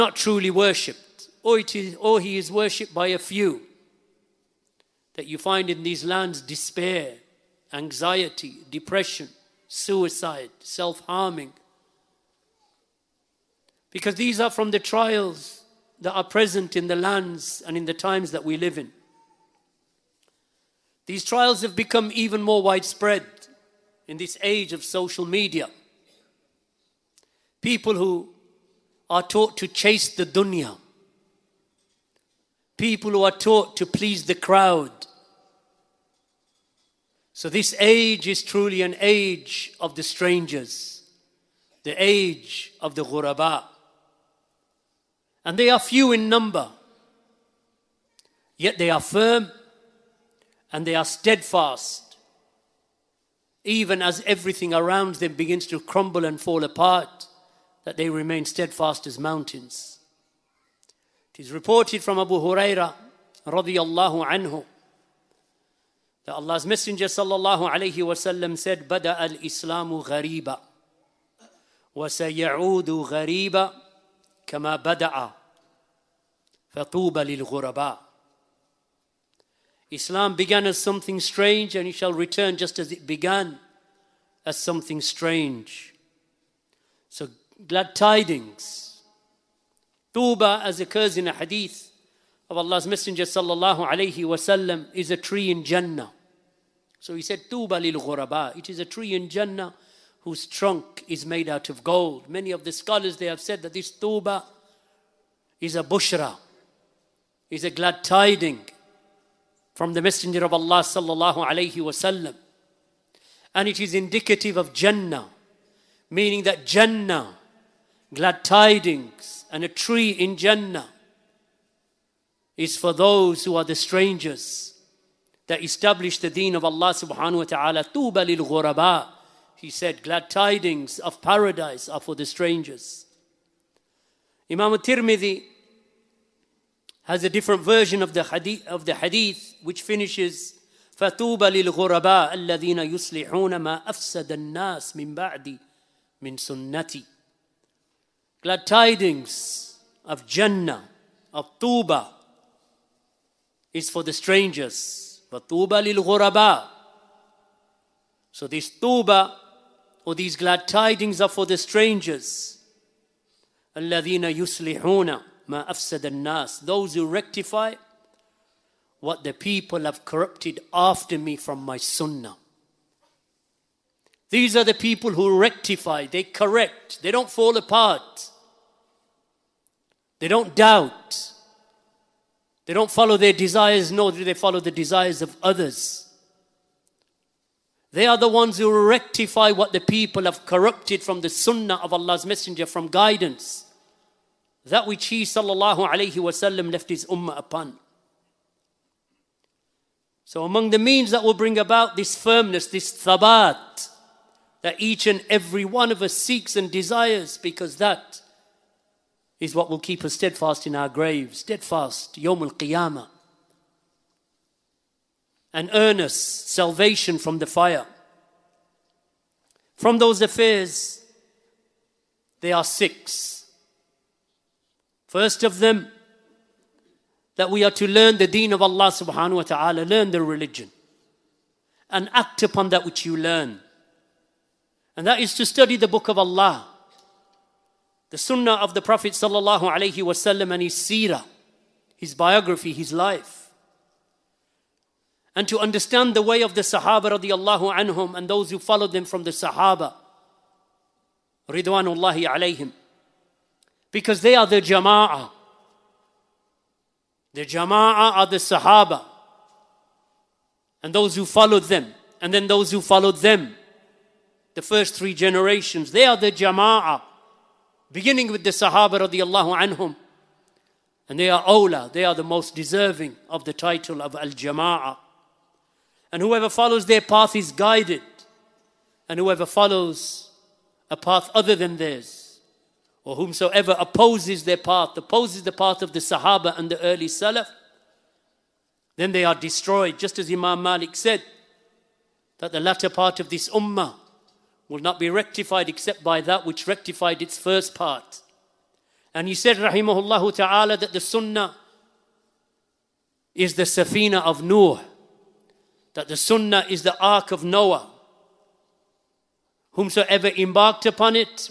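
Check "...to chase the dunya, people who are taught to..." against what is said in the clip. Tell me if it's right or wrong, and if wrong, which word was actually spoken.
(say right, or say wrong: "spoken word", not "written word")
right.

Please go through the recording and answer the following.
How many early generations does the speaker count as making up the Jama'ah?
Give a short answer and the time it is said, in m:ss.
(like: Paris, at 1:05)
3, at 4:24.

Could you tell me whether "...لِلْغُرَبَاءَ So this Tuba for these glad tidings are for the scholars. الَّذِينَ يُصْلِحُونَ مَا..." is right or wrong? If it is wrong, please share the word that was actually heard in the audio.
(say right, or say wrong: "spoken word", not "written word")
wrong: "strangers", not "scholars".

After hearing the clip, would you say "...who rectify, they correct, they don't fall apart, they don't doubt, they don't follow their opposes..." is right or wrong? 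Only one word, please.
wrong.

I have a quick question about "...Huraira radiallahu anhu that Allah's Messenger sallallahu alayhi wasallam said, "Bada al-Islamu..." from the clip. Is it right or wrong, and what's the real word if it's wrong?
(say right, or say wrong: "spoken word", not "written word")
right.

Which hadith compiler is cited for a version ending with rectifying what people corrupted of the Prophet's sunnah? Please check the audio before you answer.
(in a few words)
Imam Tirmidhi.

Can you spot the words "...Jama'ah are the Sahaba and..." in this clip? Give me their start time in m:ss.
4:17.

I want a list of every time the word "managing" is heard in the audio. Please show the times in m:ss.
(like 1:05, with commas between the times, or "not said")
not said.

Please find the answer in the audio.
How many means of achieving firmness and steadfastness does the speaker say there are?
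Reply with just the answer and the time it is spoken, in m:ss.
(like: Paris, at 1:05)
6, at 3:42.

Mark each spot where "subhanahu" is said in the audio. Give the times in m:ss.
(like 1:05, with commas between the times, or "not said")
2:06, 3:48.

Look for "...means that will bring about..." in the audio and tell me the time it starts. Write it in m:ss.
3:20.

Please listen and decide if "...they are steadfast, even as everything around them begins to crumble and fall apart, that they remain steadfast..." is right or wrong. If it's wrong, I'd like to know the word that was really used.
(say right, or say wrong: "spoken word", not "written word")
right.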